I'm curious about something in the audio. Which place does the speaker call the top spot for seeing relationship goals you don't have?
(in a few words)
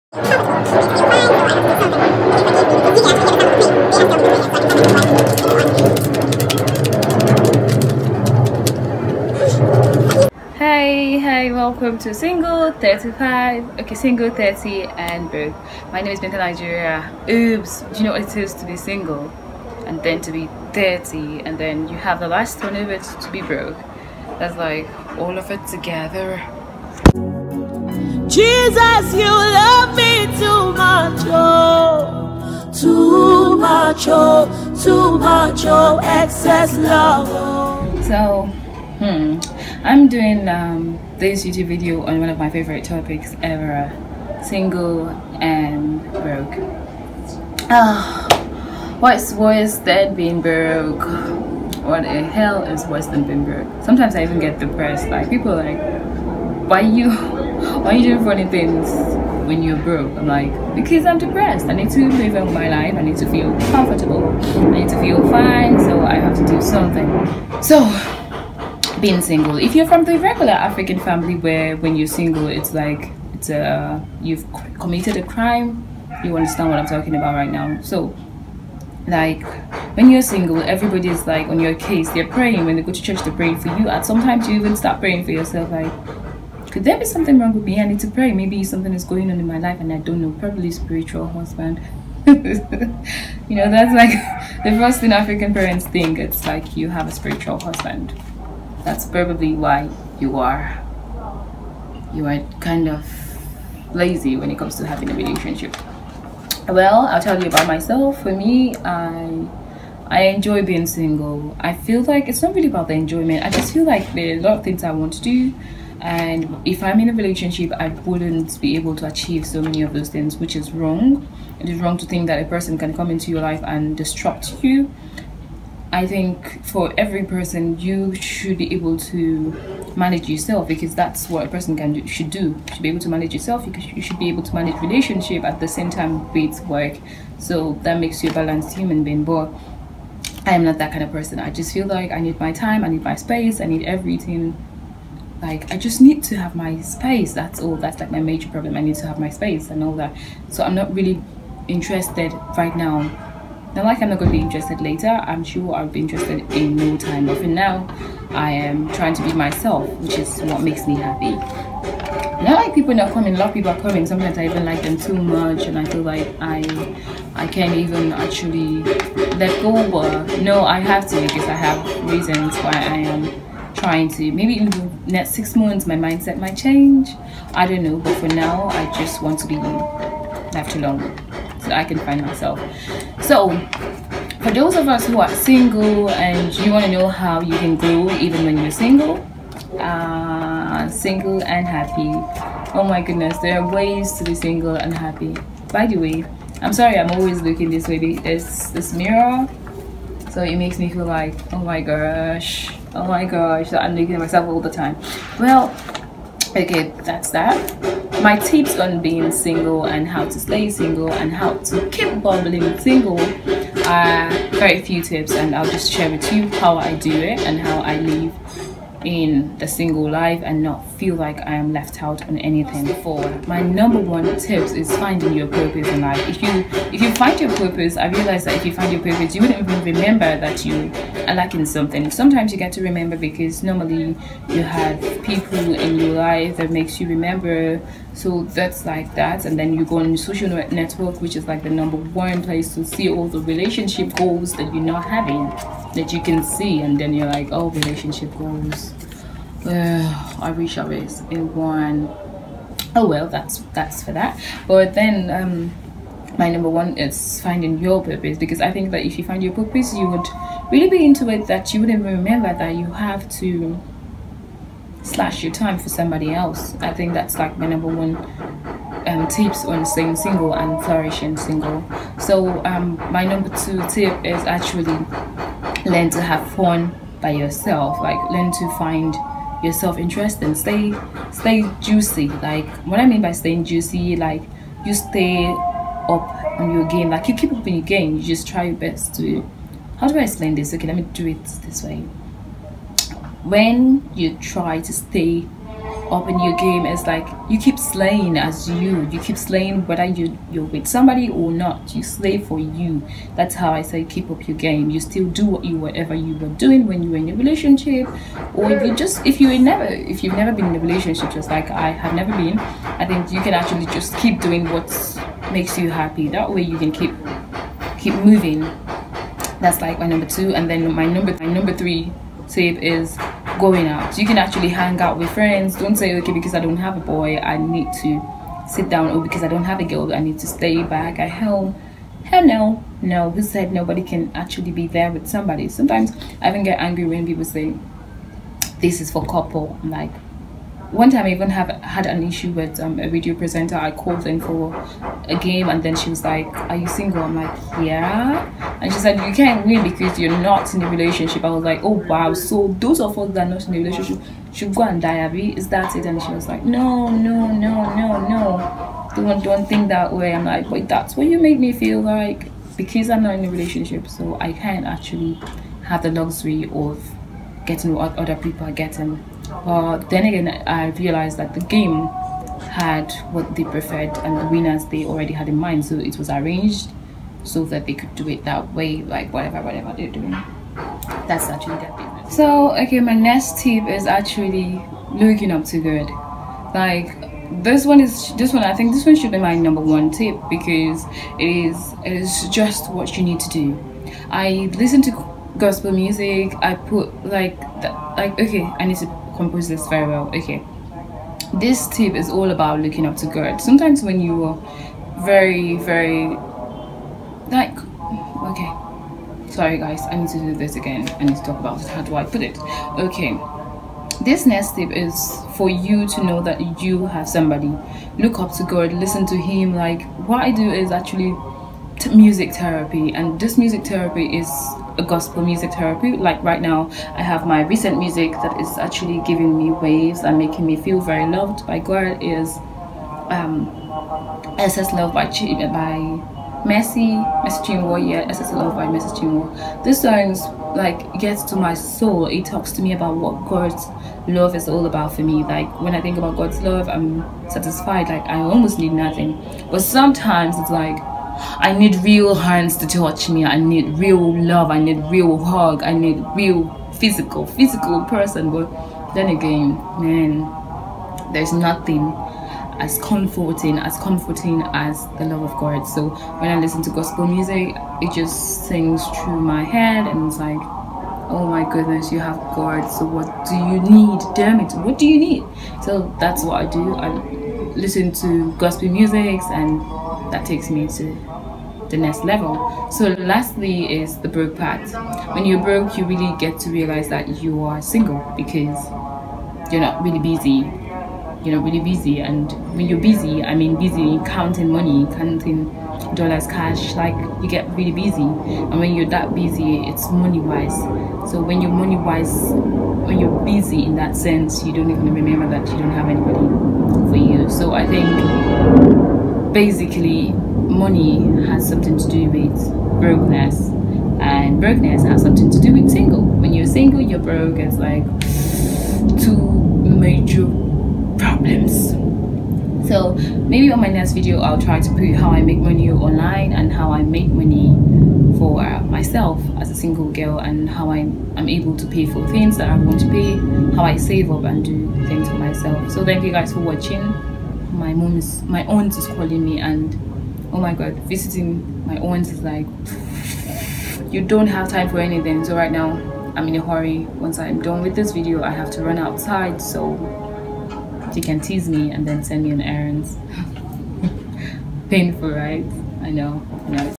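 Social network.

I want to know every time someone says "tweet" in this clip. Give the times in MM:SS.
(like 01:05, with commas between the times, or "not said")
not said.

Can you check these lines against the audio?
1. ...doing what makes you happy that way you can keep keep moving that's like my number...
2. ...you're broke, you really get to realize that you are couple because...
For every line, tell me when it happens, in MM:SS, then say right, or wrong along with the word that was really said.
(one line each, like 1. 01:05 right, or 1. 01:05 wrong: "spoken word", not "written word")
1. 05:14 right
2. 08:05 wrong: "single", not "couple".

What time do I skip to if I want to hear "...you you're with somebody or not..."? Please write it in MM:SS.
05:00.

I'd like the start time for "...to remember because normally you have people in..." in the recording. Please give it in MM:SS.
03:52.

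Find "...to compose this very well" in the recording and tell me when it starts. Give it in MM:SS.
06:38.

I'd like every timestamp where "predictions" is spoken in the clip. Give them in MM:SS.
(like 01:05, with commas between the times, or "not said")
not said.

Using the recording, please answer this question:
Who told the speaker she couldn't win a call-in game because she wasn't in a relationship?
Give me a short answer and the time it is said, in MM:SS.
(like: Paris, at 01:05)
A radio presenter, at 05:43.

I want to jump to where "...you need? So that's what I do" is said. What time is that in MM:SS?
07:55.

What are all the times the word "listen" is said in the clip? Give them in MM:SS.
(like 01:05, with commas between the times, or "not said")
06:34, 06:58, 07:46, 07:57.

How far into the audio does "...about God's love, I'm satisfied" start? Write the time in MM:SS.
07:26.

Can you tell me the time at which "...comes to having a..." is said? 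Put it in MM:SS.
01:44.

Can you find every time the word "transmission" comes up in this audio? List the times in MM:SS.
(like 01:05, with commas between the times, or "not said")
not said.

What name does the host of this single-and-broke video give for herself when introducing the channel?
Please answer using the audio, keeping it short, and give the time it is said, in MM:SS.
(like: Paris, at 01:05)
Binta, at 00:16.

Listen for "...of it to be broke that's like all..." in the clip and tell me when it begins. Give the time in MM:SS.
00:22.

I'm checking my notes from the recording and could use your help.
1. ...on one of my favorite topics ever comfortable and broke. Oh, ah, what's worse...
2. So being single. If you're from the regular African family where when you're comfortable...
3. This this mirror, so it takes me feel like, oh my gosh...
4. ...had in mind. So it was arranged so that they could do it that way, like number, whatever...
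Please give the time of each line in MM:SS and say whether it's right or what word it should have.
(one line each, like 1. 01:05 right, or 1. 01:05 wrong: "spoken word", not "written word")
1. 00:42 wrong: "single", not "comfortable"
2. 01:07 wrong: "single", not "comfortable"
3. 03:17 wrong: "makes", not "takes"
4. 06:15 wrong: "whatever", not "number".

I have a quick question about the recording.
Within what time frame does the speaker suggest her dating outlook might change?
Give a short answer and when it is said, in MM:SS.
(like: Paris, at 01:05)
6 months, at 02:55.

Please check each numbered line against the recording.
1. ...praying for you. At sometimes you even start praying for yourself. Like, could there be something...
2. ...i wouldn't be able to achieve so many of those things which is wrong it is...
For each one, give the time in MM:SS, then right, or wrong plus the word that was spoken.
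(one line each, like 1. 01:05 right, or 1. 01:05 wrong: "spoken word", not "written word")
1. 01:23 right
2. 01:57 right.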